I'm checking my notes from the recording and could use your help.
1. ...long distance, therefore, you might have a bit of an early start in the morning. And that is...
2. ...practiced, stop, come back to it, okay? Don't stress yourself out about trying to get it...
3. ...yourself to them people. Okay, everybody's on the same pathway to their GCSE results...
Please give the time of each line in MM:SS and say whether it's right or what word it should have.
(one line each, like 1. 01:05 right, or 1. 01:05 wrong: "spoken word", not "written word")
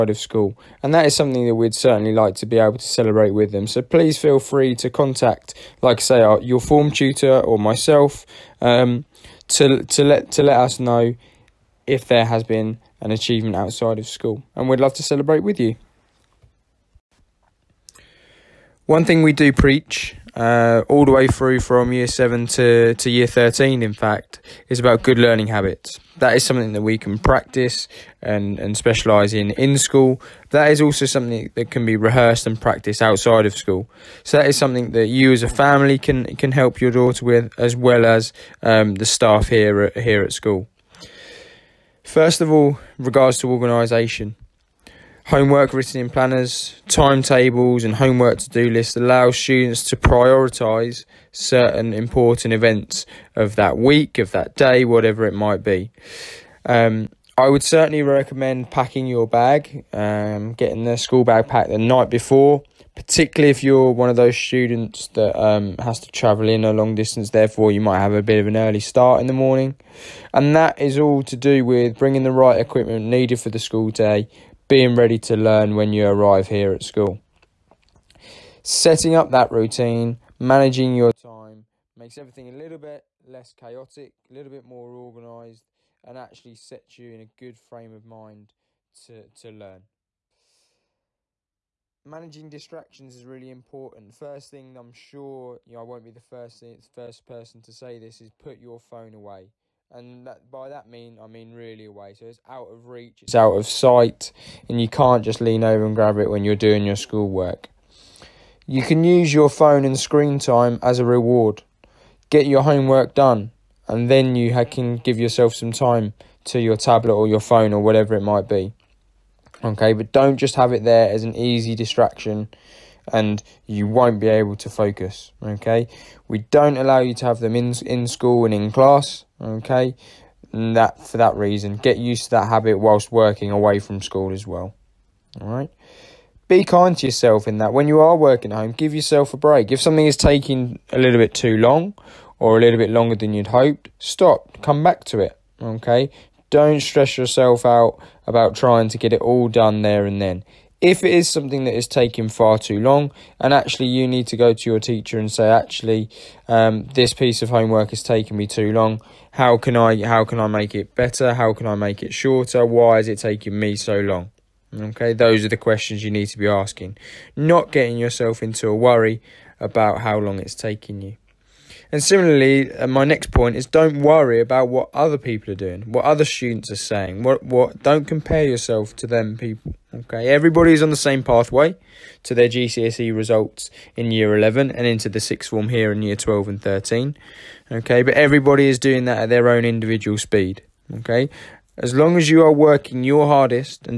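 1. 01:06 right
2. 02:23 wrong: "hoped", not "practiced"
3. 02:58 right.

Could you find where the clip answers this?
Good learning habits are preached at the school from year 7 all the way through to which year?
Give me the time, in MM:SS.
00:23.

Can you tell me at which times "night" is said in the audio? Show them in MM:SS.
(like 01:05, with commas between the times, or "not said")
01:01.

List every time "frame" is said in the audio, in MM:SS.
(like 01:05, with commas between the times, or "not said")
01:27.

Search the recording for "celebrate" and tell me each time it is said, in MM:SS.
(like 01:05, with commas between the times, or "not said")
00:02, 00:15.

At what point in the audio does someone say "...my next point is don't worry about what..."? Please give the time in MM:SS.
02:52.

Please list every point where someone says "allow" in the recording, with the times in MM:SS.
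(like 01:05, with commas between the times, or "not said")
00:48, 02:06.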